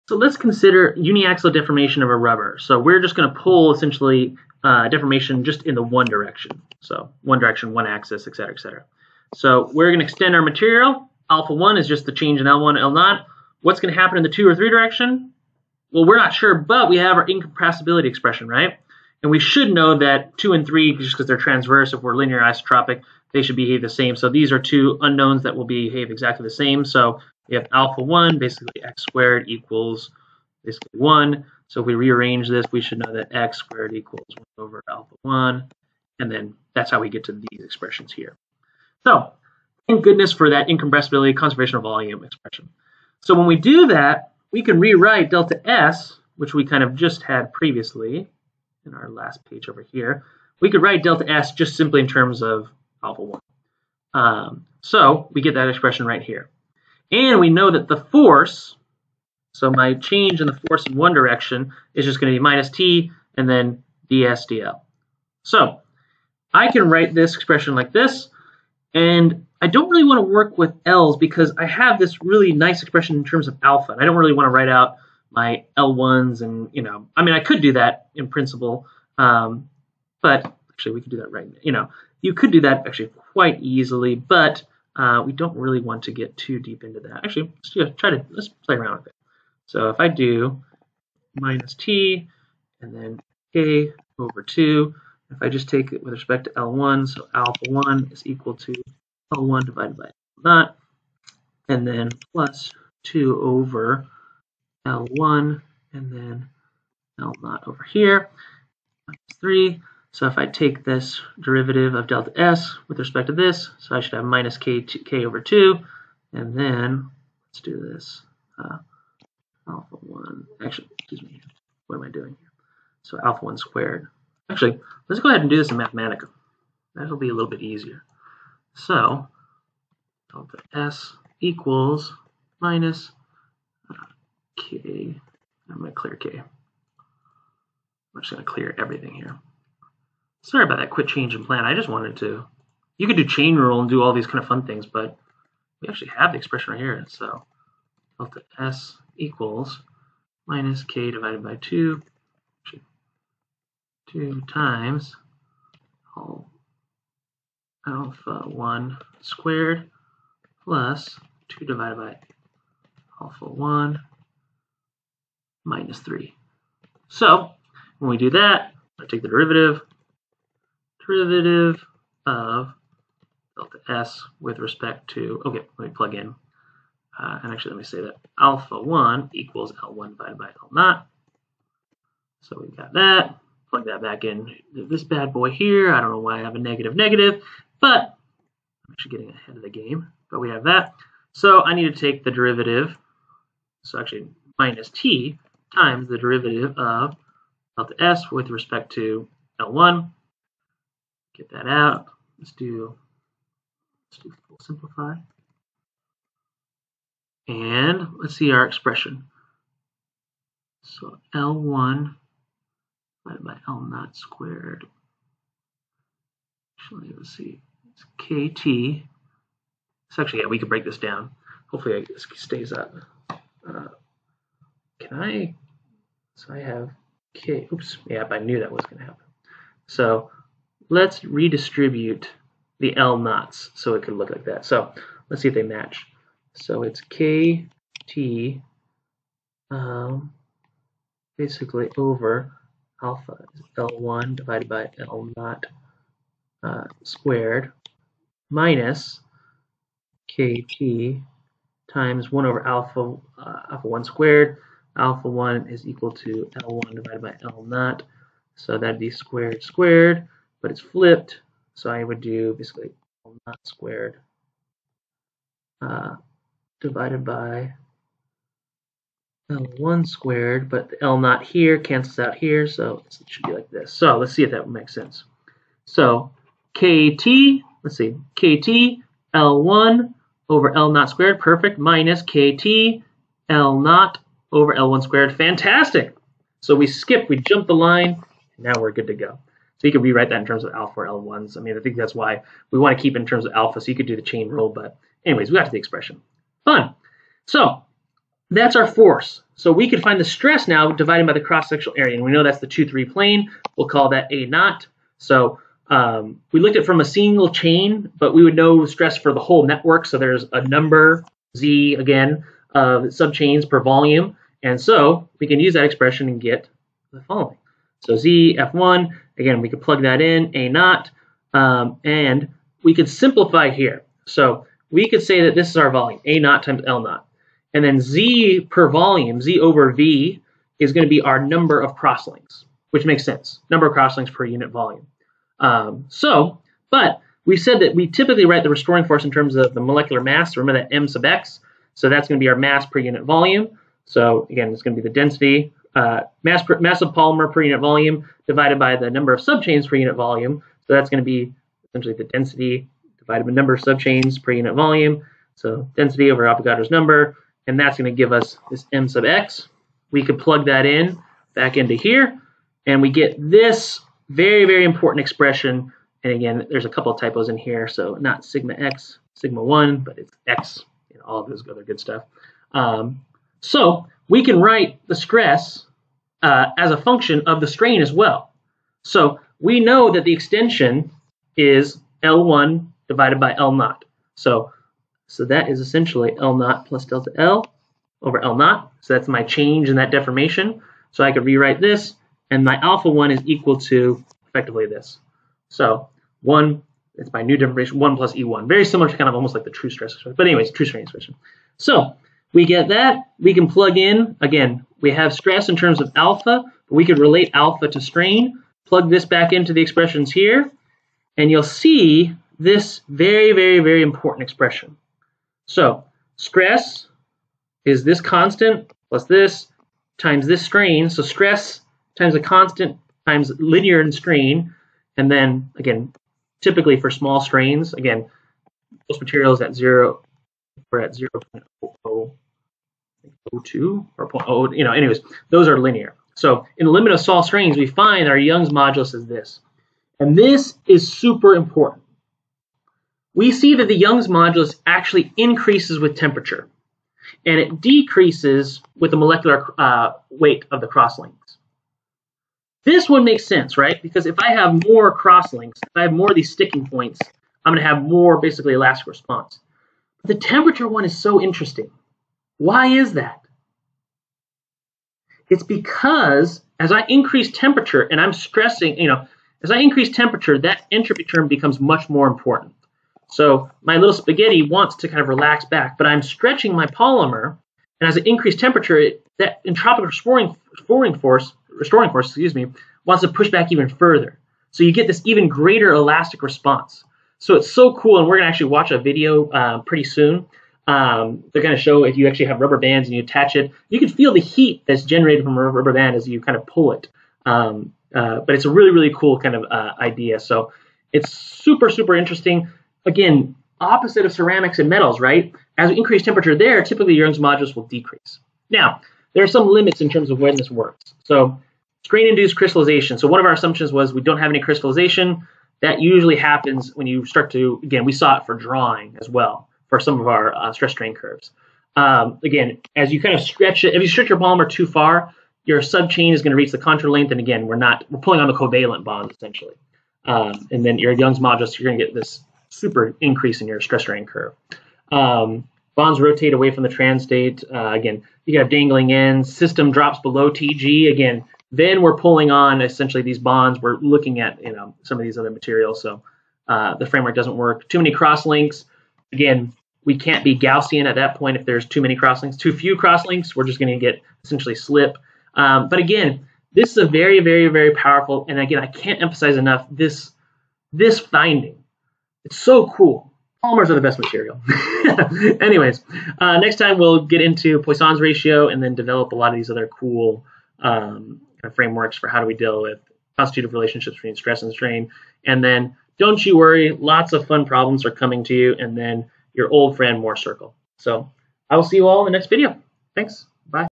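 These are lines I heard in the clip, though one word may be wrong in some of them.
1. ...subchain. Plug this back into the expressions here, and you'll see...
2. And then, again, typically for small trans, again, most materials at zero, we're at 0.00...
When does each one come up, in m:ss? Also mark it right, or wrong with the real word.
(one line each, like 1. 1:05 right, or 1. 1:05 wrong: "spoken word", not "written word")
1. 6:48 wrong: "strain", not "subchain"
2. 7:05 wrong: "strains", not "trans".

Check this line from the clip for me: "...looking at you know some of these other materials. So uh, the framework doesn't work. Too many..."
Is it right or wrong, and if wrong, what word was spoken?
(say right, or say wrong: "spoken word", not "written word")
right.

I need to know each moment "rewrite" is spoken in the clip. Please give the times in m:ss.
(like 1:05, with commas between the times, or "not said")
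0:44, 4:50, 6:31.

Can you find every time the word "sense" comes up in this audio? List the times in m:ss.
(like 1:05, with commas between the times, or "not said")
4:34, 5:33, 7:33.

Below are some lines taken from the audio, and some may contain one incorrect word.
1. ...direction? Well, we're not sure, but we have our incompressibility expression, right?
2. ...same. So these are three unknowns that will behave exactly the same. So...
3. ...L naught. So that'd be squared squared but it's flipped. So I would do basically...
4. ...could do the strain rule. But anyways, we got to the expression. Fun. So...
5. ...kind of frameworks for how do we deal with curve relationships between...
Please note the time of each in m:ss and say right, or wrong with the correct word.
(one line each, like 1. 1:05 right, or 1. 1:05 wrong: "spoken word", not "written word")
1. 0:14 right
2. 0:23 wrong: "two", not "three"
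3. 4:17 right
4. 4:53 wrong: "chain", not "strain"
5. 9:31 wrong: "constitutive", not "curve".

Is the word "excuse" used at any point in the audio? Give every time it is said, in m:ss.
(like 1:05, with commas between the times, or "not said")
2:00, 8:02.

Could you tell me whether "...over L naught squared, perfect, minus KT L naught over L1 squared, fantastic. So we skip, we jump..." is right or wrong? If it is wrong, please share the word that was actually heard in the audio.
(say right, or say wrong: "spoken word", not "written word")
right.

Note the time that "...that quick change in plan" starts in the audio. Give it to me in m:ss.
2:20.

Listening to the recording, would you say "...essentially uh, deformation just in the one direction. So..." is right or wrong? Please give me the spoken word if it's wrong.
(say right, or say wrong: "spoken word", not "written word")
right.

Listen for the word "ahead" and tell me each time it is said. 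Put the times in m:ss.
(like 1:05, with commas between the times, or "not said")
2:05, 3:09.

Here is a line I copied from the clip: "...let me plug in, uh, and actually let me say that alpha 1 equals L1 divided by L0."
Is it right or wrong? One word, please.
right.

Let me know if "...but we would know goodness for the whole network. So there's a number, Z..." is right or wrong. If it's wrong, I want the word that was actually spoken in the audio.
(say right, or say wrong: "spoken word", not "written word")
wrong: "stress", not "goodness".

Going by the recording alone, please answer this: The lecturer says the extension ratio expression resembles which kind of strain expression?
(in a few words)
true strain.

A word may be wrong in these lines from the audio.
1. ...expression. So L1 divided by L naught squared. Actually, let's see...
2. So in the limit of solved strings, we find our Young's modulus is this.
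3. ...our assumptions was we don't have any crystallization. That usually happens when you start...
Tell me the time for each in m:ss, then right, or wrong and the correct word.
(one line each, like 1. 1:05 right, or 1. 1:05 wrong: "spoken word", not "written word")
1. 3:28 right
2. 7:16 right
3. 8:33 right.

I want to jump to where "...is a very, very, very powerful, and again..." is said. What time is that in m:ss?
9:16.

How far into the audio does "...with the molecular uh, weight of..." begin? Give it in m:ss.
7:28.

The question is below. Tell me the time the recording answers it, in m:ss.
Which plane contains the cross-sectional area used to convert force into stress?
5:02.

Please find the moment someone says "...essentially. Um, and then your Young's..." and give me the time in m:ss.
8:49.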